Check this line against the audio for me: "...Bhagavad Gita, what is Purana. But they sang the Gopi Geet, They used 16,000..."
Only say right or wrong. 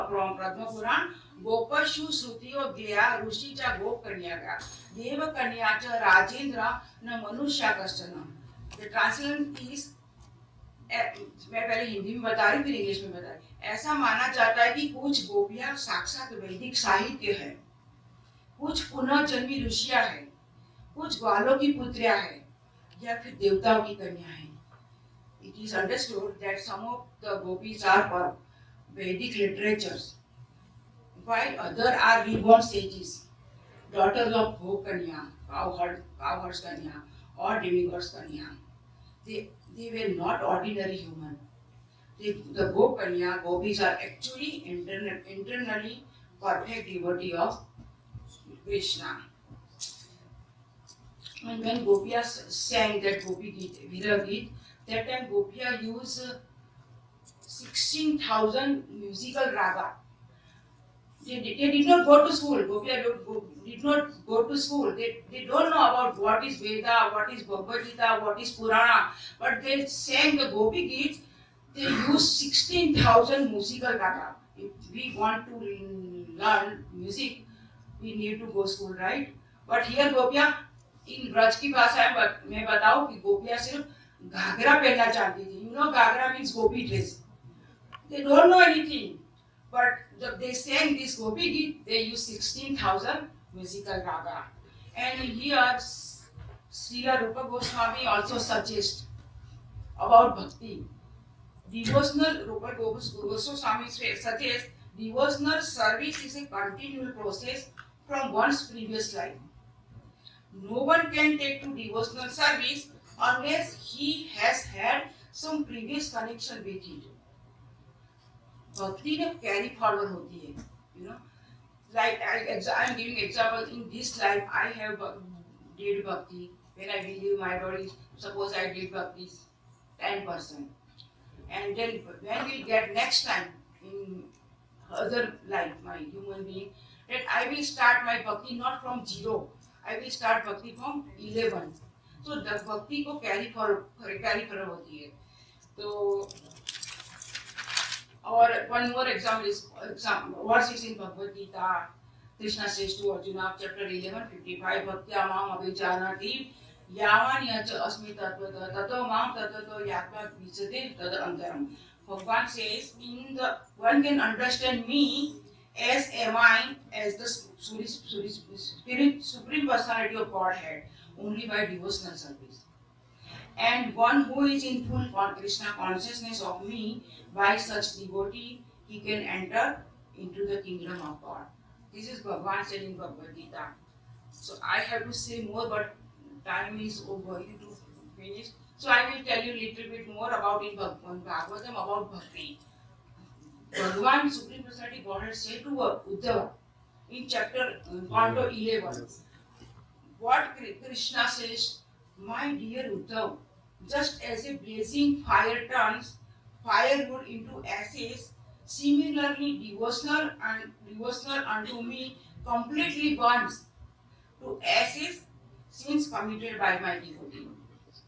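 right.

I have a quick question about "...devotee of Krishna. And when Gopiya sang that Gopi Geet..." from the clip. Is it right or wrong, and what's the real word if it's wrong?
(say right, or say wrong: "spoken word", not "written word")
right.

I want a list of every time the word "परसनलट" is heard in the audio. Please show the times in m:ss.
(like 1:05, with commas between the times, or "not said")
3:14.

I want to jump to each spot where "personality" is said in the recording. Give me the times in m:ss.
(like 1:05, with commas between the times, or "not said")
2:49.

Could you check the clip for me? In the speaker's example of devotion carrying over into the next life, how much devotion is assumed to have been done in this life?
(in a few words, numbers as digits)
10 percent.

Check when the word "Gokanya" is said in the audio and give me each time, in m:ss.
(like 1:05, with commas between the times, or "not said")
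0:42.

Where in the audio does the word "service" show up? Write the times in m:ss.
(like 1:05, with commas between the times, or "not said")
1:52, 2:52.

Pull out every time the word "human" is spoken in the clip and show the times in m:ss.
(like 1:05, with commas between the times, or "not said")
0:40, 2:15.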